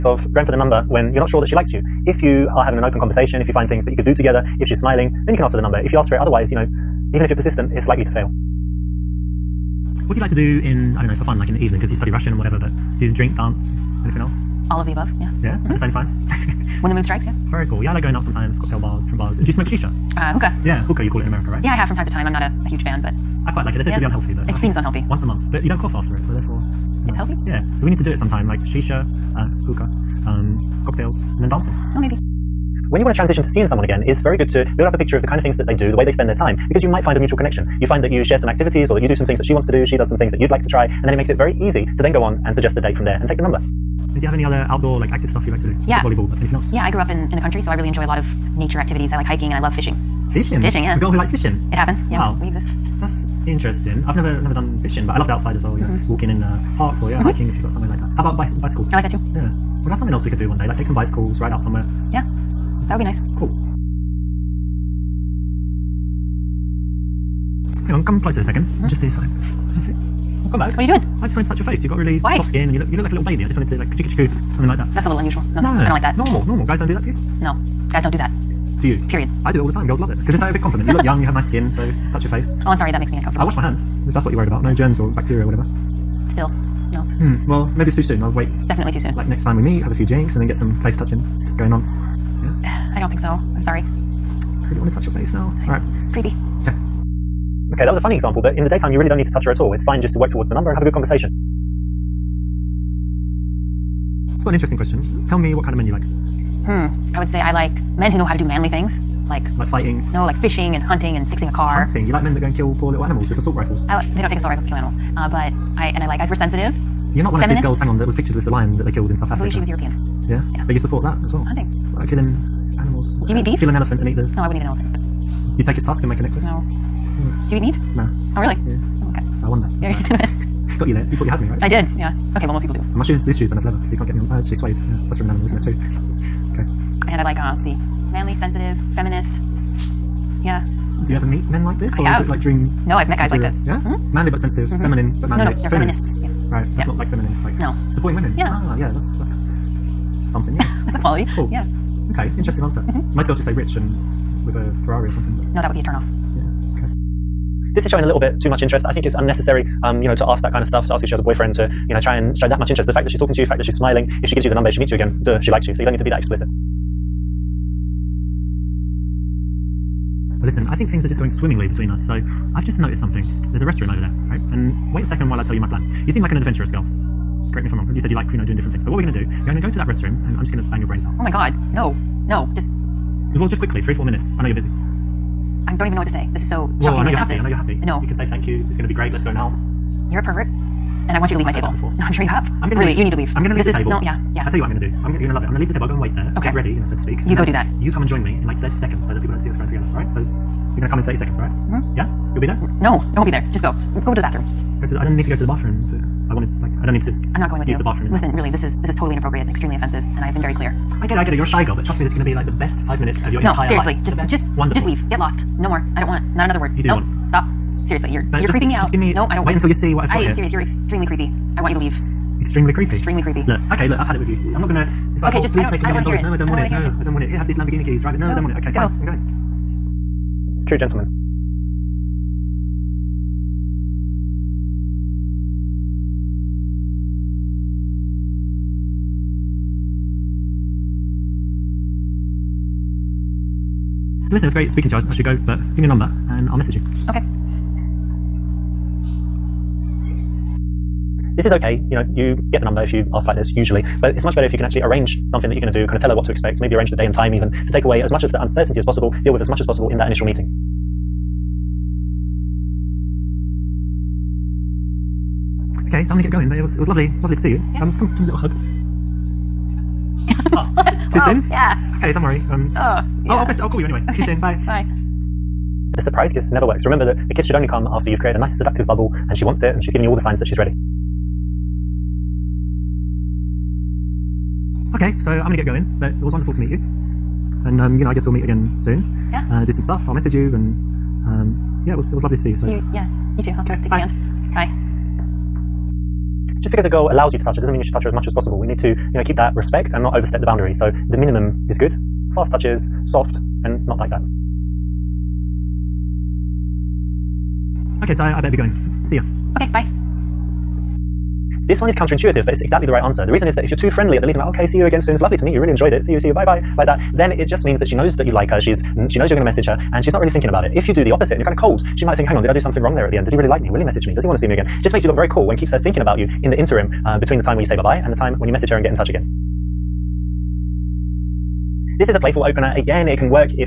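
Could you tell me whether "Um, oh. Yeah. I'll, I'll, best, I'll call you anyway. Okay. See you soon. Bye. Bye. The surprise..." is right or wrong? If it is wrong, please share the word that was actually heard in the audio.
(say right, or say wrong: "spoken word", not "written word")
right.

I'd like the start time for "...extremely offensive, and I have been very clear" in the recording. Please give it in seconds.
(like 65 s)
209 s.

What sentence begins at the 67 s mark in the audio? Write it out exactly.
Hang on, come closer a 2nd mm -hmm.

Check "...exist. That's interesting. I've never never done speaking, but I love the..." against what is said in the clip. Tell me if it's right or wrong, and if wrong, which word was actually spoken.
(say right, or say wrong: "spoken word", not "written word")
wrong: "fishing", not "speaking".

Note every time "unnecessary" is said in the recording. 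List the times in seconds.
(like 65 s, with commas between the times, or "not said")
159 s.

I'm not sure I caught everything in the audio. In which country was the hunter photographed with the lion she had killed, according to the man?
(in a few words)
South Africa.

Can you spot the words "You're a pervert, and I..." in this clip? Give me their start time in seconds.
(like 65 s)
190 s.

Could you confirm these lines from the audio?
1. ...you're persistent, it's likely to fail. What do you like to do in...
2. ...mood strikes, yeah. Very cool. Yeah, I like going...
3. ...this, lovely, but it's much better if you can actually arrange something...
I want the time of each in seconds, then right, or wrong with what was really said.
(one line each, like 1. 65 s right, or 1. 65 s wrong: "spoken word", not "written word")
1. 7 s right
2. 16 s right
3. 253 s wrong: "usually", not "lovely".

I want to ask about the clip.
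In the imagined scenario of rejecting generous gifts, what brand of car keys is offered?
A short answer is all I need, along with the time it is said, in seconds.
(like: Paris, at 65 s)
Lamborghini, at 227 s.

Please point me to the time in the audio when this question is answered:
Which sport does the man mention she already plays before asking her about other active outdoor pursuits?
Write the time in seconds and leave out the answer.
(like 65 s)
46 s.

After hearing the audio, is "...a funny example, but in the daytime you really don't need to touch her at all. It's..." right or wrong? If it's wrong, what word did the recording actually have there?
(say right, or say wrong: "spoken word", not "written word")
right.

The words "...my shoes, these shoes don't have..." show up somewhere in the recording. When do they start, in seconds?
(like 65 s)
132 s.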